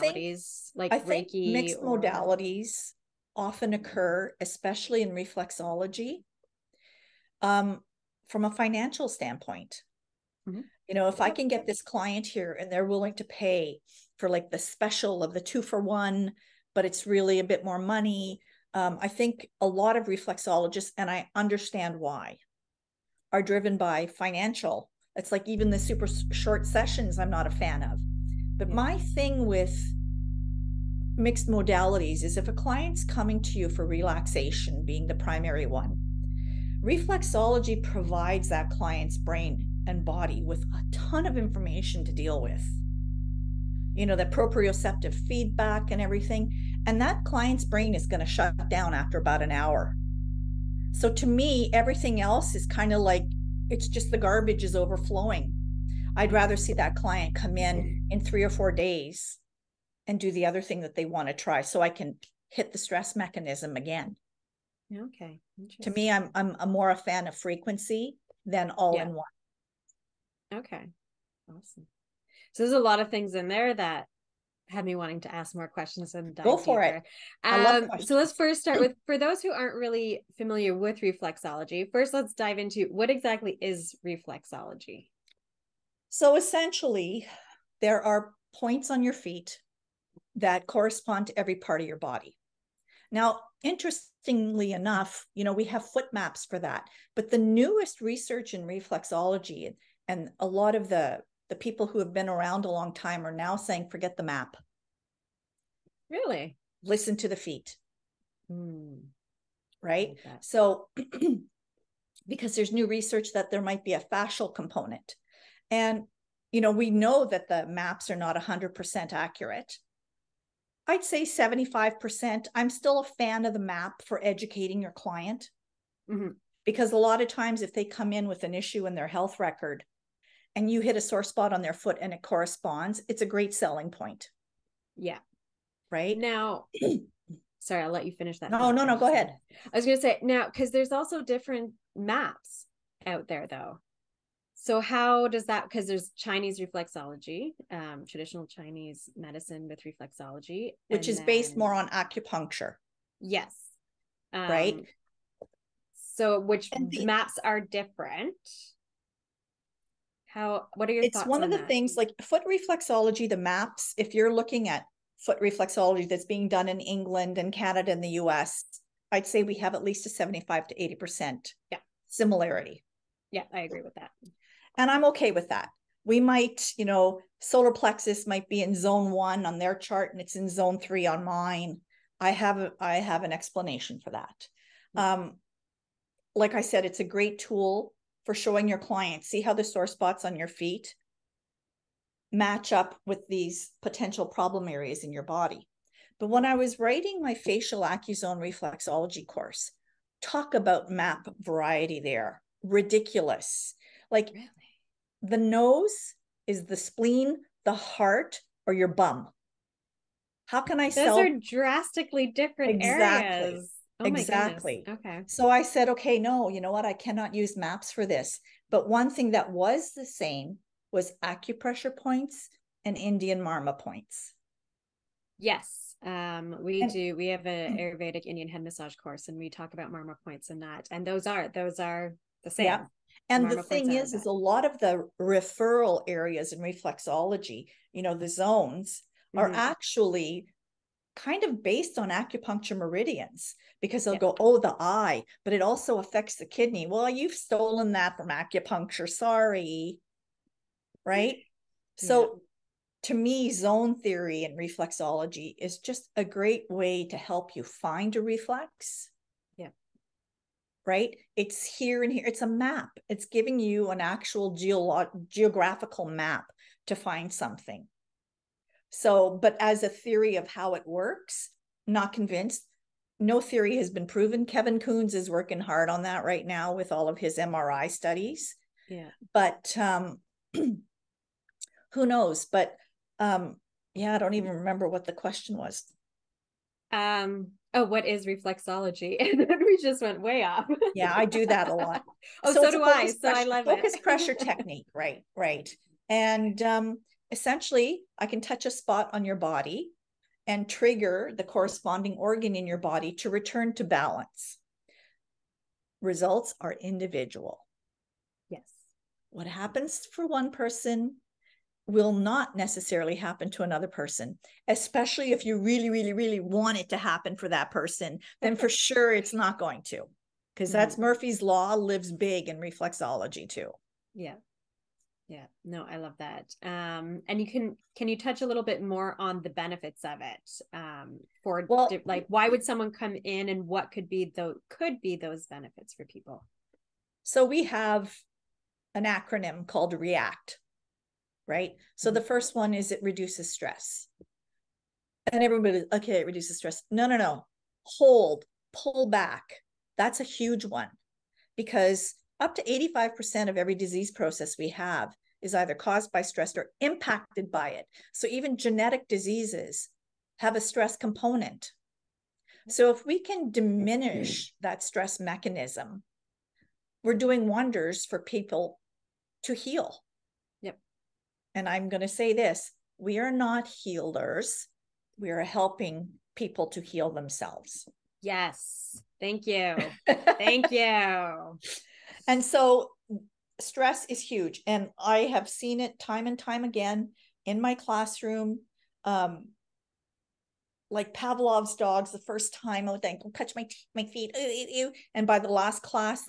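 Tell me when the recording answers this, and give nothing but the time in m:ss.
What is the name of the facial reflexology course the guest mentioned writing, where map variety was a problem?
3:17.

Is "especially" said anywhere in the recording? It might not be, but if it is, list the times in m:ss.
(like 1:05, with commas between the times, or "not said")
0:04, 5:14.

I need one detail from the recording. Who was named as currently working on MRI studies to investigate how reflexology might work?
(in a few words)
Kevin Coons.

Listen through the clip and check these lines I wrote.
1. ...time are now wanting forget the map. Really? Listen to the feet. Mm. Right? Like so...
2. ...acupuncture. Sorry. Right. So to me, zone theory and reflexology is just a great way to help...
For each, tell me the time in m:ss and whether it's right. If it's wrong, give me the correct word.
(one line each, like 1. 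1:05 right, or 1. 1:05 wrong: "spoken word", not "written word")
1. 1:42 wrong: "saying", not "wanting"
2. 4:08 right.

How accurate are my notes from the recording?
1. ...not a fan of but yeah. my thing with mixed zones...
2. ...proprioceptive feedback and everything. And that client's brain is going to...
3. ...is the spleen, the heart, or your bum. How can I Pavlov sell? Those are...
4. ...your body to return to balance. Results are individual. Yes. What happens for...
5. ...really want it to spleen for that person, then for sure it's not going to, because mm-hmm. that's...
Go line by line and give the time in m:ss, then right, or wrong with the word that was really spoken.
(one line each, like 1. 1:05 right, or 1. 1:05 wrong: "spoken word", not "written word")
1. 0:27 wrong: "modalities", not "zones"
2. 0:44 right
3. 3:26 wrong: "Those", not "Pavlov"
4. 5:02 right
5. 5:16 wrong: "happen", not "spleen".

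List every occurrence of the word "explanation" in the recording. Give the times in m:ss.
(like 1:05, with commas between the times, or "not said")
3:03.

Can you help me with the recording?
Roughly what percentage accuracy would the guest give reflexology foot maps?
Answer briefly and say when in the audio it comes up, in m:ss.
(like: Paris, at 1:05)
75%, at 2:00.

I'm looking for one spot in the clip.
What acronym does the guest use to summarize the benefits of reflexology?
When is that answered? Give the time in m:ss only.
5:39.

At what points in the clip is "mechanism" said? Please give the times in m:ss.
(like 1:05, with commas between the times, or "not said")
1:03, 6:05.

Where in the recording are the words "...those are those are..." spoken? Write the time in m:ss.
3:51.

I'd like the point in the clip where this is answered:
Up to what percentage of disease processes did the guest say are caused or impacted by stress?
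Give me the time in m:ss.
5:52.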